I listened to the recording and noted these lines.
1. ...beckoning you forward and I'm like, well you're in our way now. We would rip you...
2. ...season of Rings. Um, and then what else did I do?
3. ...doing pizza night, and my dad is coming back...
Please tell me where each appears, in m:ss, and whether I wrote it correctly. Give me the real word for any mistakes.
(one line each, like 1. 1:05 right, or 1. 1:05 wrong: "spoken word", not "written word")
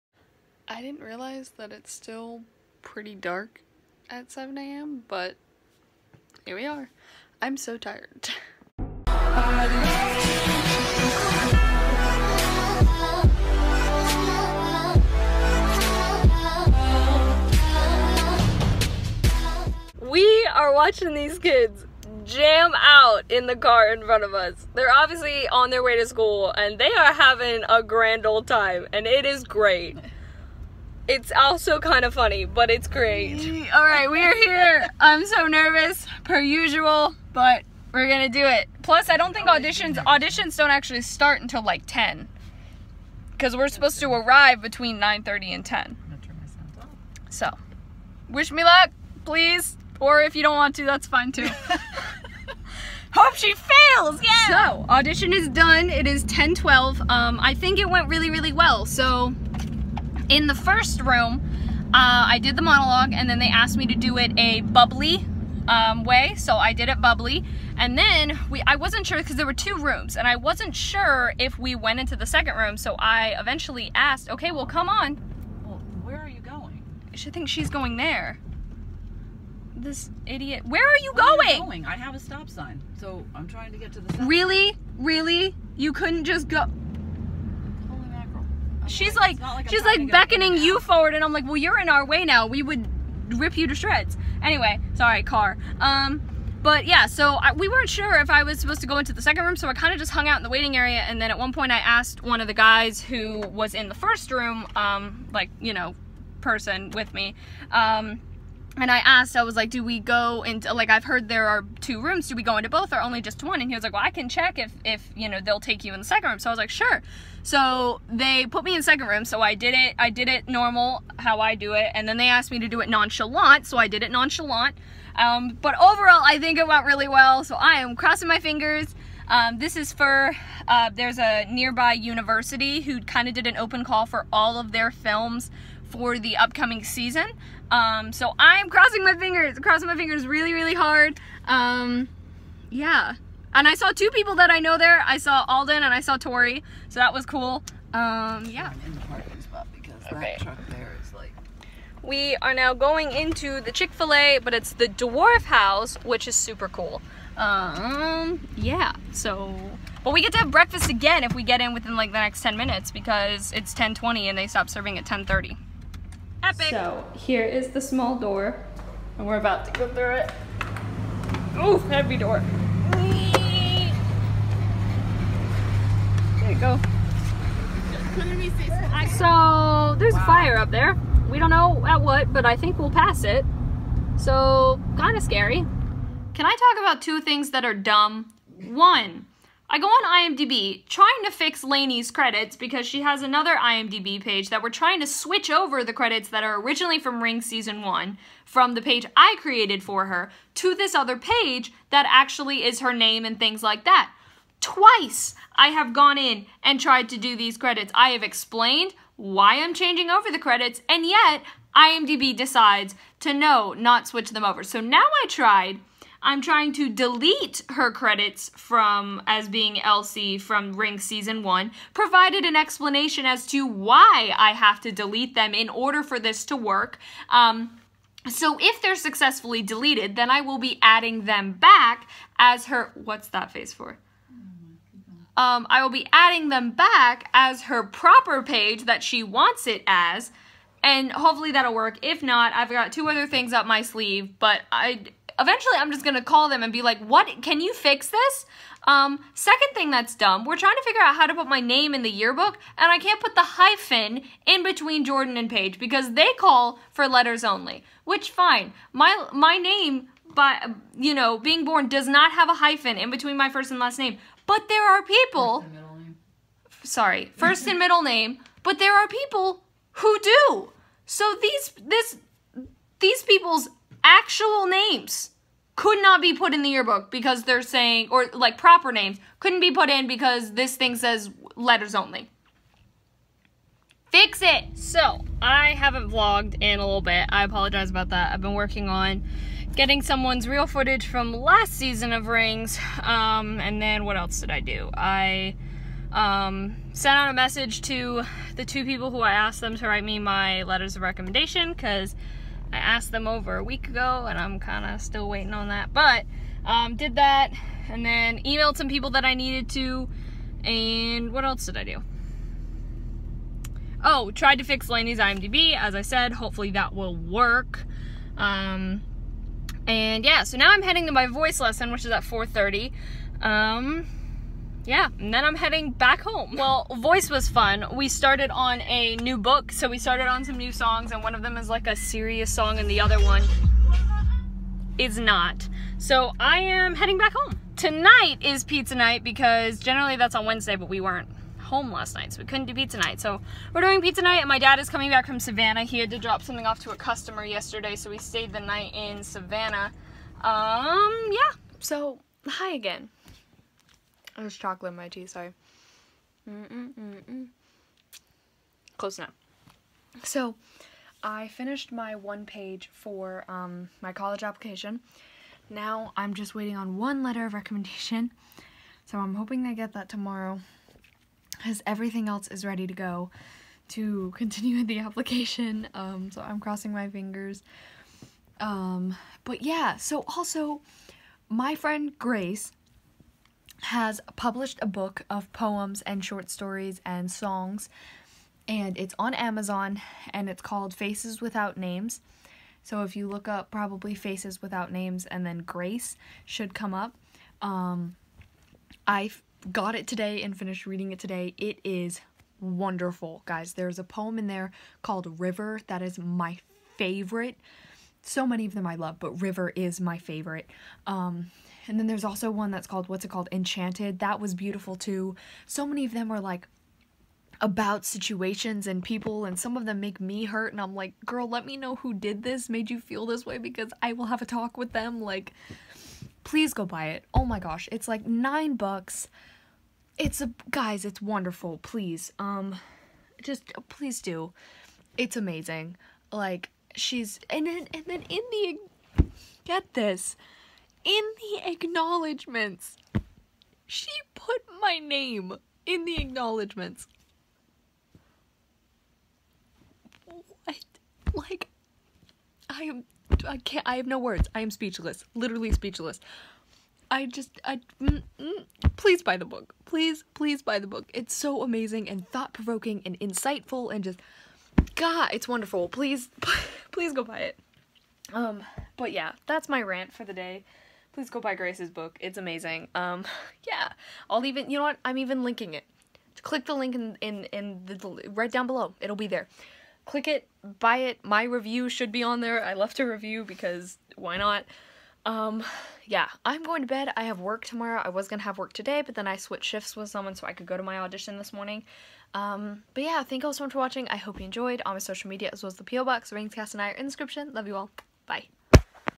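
1. 1:30 right
2. 4:51 right
3. 5:43 right.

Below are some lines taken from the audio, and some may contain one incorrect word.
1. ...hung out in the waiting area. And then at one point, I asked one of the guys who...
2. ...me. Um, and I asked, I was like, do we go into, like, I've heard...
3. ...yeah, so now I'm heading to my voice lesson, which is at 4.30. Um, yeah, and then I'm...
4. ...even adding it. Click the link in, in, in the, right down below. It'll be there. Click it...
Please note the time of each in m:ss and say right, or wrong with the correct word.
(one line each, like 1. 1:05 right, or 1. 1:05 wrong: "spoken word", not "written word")
1. 1:40 right
2. 1:47 right
3. 5:20 right
4. 7:55 wrong: "linking", not "adding".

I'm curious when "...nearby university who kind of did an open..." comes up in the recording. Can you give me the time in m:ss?
2:11.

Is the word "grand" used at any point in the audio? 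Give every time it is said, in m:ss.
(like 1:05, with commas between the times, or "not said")
0:27.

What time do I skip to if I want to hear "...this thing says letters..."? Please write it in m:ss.
4:40.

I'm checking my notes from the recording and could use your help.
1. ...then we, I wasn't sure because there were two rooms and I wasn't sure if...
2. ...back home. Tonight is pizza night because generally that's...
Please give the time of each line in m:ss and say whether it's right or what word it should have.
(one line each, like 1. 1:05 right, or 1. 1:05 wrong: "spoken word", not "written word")
1. 1:07 right
2. 5:37 right.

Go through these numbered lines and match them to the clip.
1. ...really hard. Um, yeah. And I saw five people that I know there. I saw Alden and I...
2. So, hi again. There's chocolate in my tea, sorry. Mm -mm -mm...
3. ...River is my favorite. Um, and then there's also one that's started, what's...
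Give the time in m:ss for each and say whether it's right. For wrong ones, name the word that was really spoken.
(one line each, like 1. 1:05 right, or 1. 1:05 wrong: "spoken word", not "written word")
1. 2:20 wrong: "two", not "five"
2. 5:51 right
3. 6:49 wrong: "called", not "started".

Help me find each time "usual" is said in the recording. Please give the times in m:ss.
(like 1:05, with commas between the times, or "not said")
0:36.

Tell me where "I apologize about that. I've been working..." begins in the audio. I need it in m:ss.
4:47.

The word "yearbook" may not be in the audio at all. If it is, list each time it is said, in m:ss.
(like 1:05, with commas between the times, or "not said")
4:12, 4:36.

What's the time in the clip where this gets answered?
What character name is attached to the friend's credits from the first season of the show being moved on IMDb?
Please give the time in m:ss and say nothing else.
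3:39.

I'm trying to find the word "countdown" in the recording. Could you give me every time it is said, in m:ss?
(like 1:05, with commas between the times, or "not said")
not said.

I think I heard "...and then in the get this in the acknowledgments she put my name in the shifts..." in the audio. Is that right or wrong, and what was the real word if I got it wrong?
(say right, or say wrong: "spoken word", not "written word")
wrong: "acknowledgments", not "shifts".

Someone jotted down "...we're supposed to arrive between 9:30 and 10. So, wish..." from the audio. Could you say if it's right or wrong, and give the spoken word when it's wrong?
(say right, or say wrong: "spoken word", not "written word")
right.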